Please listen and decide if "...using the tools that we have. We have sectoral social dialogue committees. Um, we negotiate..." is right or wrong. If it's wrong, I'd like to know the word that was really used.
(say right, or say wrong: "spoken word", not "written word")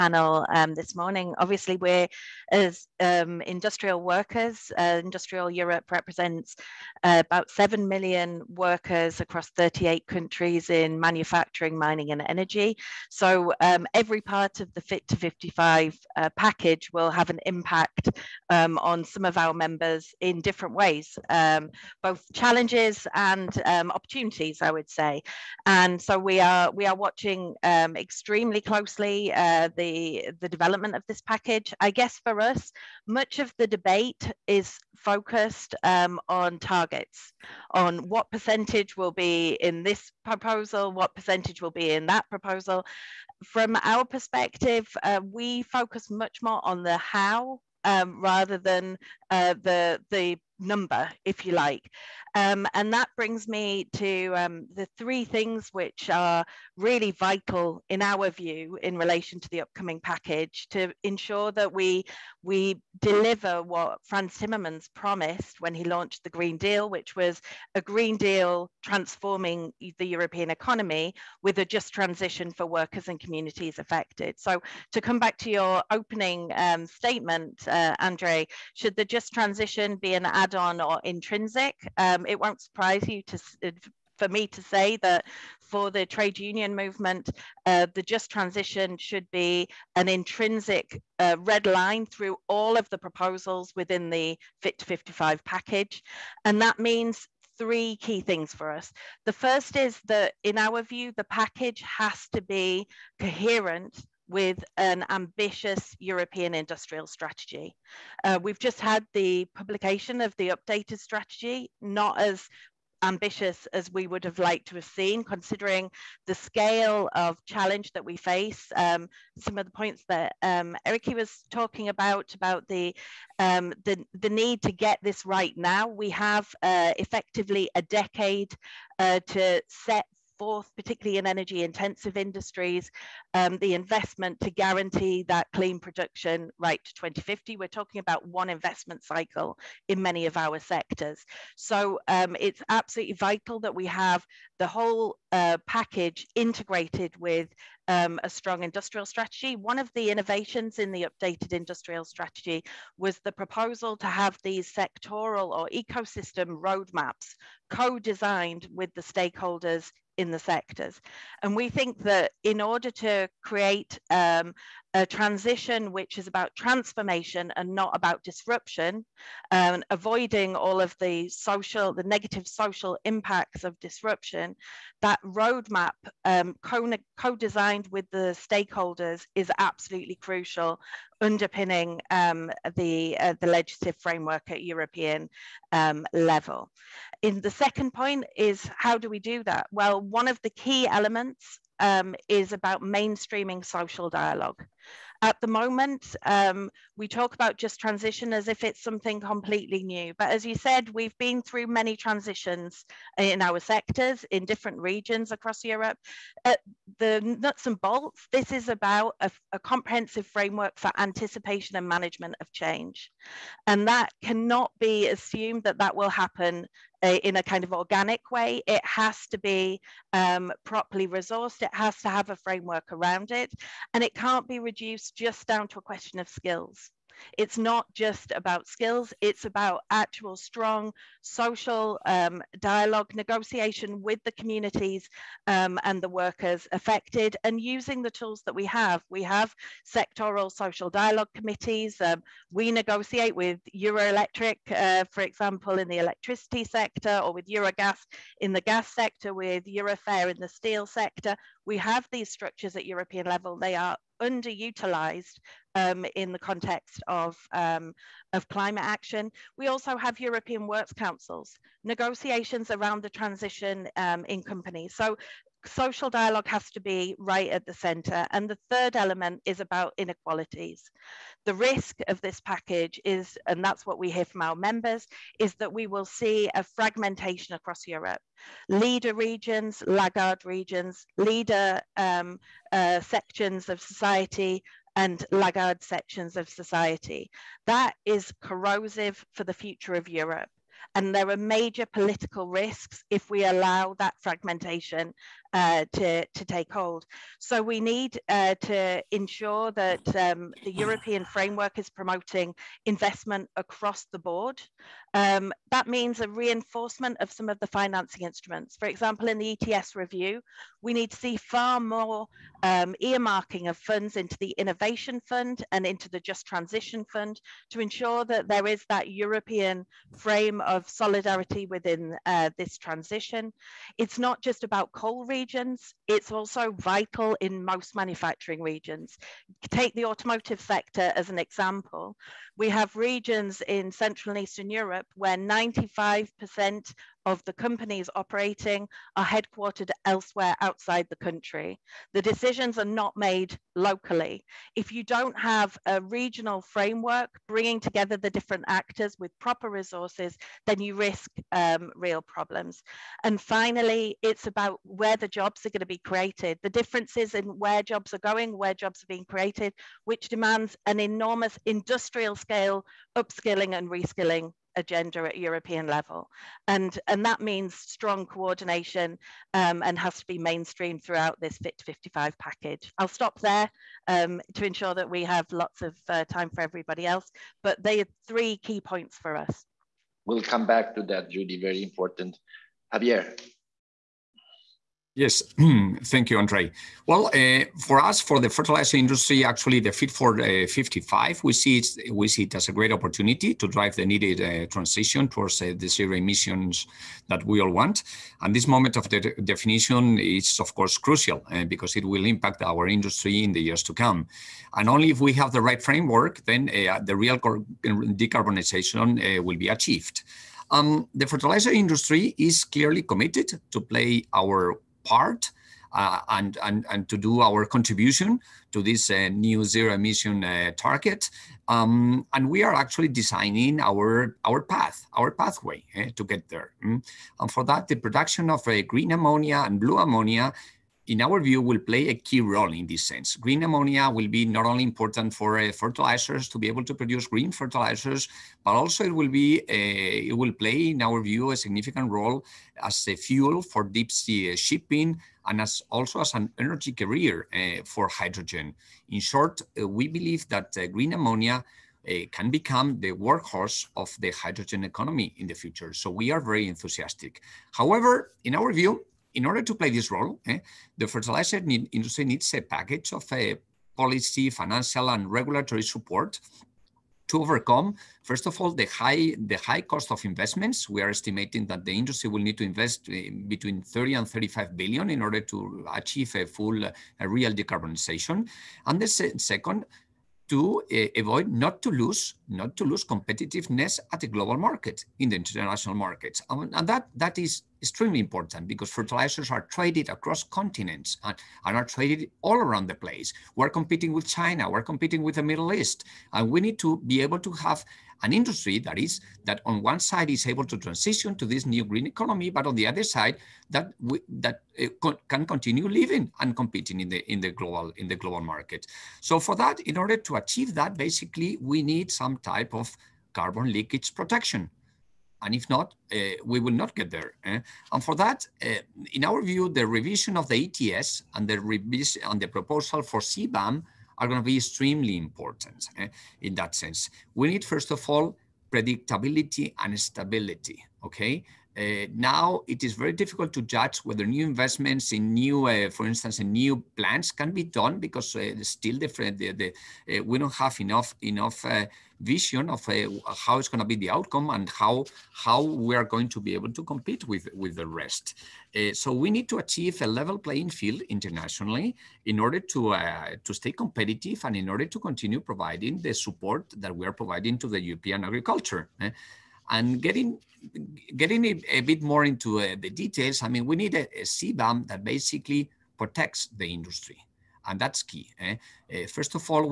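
right.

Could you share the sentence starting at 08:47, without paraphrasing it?
We need, first of all, predictability and stability, okay?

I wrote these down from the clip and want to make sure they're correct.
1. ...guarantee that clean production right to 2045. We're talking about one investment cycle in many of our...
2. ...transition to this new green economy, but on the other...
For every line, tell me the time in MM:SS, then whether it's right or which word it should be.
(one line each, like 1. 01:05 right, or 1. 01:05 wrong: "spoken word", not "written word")
1. 02:14 wrong: "2050", not "2045"
2. 08:20 right.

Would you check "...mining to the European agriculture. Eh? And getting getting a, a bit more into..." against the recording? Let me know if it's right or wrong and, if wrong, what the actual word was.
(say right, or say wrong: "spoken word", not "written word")
wrong: "providing", not "mining".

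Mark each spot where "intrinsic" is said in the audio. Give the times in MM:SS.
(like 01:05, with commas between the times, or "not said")
01:21, 01:30.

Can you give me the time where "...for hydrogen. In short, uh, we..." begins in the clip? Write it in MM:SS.
07:27.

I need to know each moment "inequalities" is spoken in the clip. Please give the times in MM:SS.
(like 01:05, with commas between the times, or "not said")
04:29.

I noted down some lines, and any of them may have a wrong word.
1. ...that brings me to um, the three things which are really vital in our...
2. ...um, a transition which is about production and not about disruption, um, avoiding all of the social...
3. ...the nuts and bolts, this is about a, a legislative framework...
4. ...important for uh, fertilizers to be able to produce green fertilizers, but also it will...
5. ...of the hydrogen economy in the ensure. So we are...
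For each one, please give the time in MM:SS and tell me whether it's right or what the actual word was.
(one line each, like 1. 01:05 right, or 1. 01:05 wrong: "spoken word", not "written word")
1. 00:52 right
2. 02:44 wrong: "transformation", not "production"
3. 03:26 wrong: "comprehensive", not "legislative"
4. 07:14 right
5. 07:33 wrong: "future", not "ensure".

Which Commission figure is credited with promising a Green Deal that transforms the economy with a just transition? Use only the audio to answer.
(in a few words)
Frans Timmermans.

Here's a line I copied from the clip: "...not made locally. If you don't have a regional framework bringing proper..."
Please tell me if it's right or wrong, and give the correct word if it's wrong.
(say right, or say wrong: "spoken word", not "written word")
wrong: "together", not "proper".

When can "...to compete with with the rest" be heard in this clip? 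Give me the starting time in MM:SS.
09:06.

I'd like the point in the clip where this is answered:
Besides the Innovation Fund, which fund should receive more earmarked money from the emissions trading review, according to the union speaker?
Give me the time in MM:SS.
05:16.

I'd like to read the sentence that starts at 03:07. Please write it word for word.
In the second point is how do we do that?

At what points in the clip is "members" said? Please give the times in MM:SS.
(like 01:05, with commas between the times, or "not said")
00:19, 04:34.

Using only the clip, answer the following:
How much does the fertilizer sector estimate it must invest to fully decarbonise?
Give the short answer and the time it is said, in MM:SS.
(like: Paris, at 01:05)
30 to 35 billion, at 07:53.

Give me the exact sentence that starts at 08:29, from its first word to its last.
So for that, in order to achieve that, basically we need some type of carbon leakage protection.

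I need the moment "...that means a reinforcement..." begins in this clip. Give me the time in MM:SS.
05:05.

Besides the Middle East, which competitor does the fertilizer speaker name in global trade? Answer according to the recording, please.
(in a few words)
China.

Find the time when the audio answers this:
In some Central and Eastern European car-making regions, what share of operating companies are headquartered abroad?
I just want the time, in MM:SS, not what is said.
05:35.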